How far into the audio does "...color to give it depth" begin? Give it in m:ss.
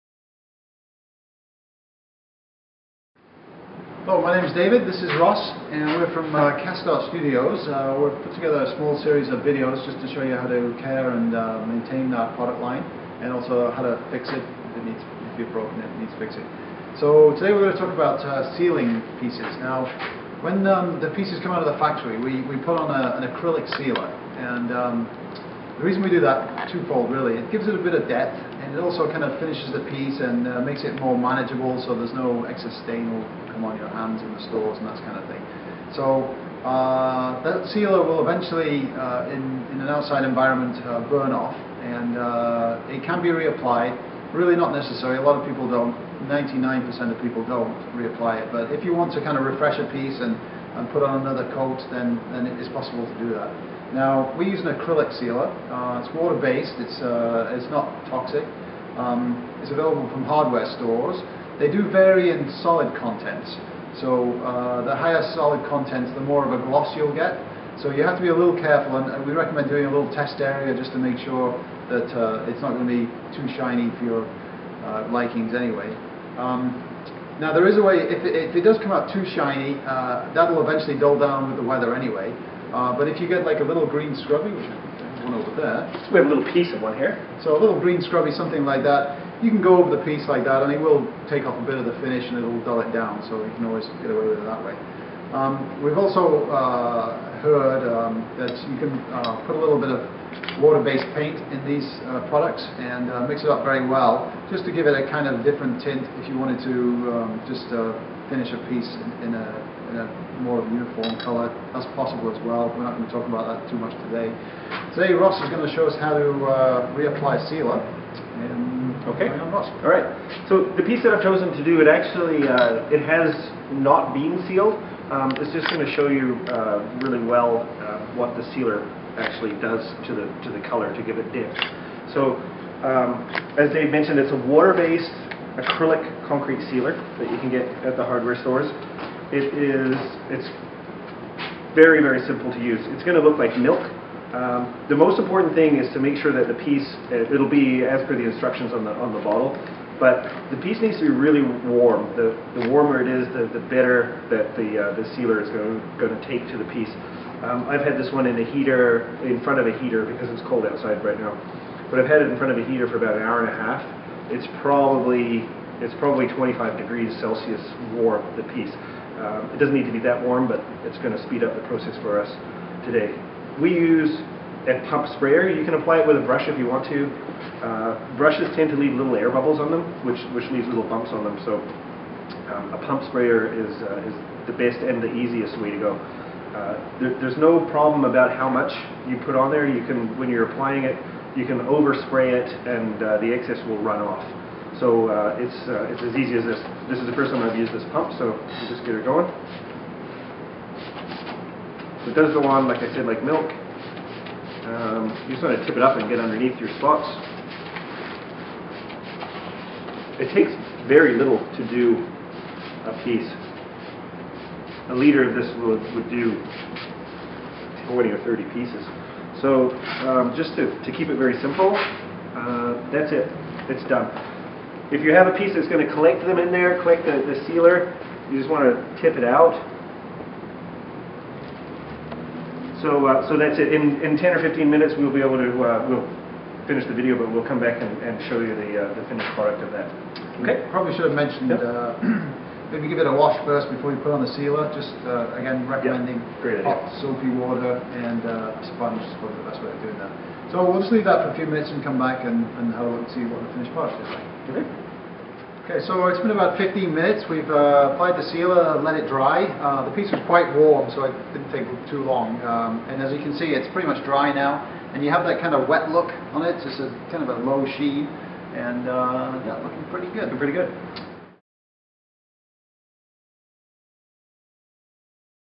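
2:10.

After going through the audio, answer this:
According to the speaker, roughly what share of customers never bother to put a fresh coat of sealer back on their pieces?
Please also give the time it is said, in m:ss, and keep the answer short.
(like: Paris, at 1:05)
99%, at 0:46.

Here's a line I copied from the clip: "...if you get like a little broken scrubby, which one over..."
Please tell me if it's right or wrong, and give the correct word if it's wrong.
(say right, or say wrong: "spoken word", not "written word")
wrong: "green", not "broken".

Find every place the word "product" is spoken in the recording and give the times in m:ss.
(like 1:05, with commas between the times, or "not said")
0:12, 1:42, 3:59, 4:13.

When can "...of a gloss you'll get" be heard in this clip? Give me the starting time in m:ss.
1:06.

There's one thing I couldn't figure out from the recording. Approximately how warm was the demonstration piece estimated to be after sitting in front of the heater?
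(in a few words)
25 degrees Celsius.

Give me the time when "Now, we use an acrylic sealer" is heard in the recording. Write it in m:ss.
0:53.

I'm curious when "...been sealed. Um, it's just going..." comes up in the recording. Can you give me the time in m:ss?
2:04.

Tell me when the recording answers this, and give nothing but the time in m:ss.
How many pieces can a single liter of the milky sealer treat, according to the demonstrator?
3:37.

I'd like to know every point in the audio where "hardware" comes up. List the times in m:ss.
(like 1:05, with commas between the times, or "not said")
1:00, 2:18.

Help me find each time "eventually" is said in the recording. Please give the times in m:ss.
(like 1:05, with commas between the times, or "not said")
0:38, 1:20.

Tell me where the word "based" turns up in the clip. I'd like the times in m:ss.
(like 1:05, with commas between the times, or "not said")
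0:56, 1:40, 2:14.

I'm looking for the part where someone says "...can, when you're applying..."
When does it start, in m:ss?
3:09.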